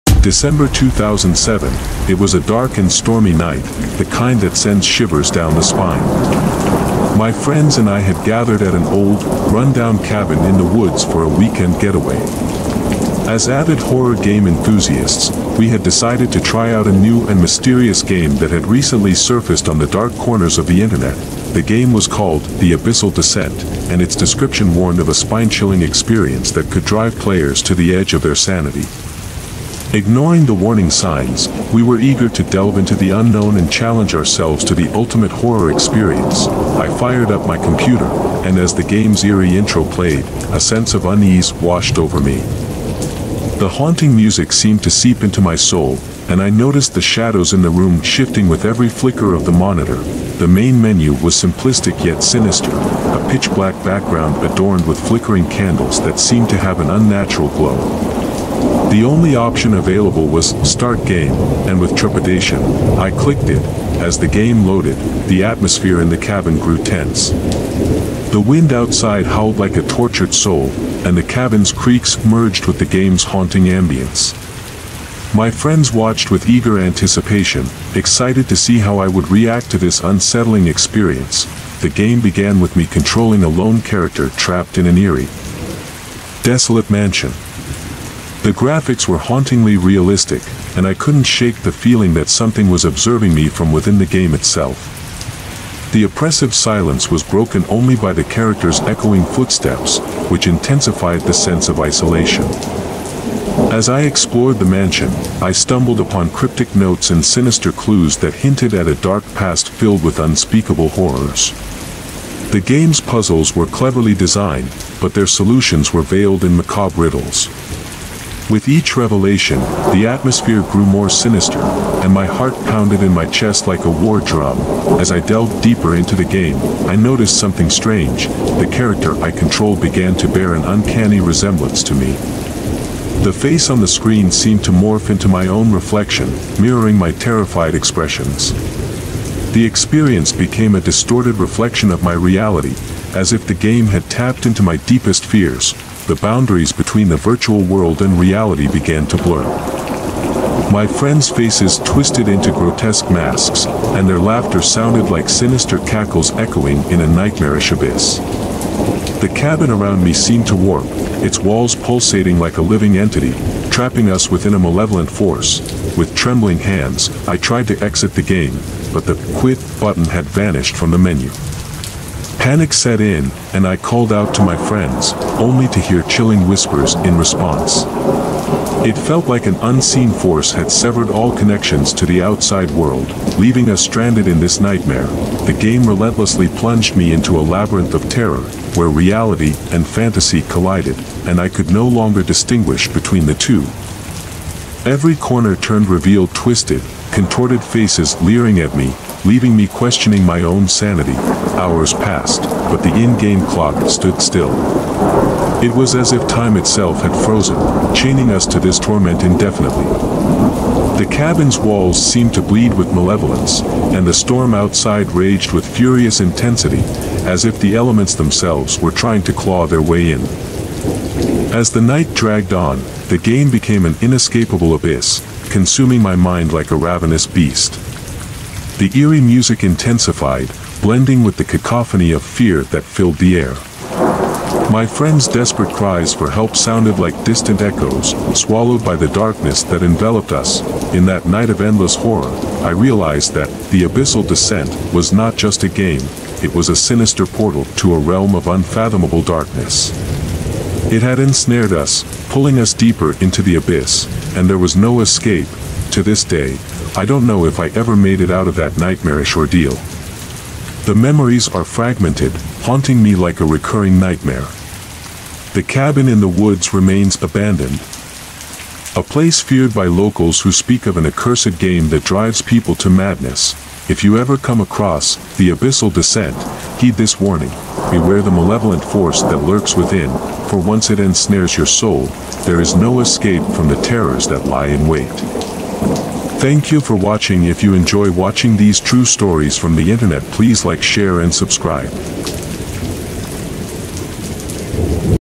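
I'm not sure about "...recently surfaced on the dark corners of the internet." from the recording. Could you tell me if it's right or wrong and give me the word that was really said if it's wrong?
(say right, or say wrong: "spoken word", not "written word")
right.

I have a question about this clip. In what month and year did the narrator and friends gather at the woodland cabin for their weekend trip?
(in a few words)
December 2007.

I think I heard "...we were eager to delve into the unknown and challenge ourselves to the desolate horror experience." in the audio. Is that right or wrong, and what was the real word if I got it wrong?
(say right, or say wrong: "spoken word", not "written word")
wrong: "ultimate", not "desolate".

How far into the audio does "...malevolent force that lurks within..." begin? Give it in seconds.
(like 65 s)
278 s.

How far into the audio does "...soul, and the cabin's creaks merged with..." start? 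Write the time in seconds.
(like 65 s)
70 s.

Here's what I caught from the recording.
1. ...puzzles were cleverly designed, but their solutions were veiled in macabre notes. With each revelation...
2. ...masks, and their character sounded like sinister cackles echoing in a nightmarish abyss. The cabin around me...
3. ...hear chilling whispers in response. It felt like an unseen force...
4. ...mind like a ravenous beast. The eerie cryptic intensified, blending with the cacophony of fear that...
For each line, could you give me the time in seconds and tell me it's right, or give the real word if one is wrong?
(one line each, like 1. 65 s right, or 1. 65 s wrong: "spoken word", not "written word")
1. 113 s wrong: "riddles", not "notes"
2. 153 s wrong: "laughter", not "character"
3. 175 s right
4. 226 s wrong: "music", not "cryptic".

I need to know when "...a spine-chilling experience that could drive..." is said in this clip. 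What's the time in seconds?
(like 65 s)
25 s.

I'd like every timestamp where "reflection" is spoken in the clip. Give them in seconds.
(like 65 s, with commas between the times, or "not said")
135 s, 141 s.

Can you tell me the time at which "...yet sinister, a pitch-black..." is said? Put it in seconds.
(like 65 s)
52 s.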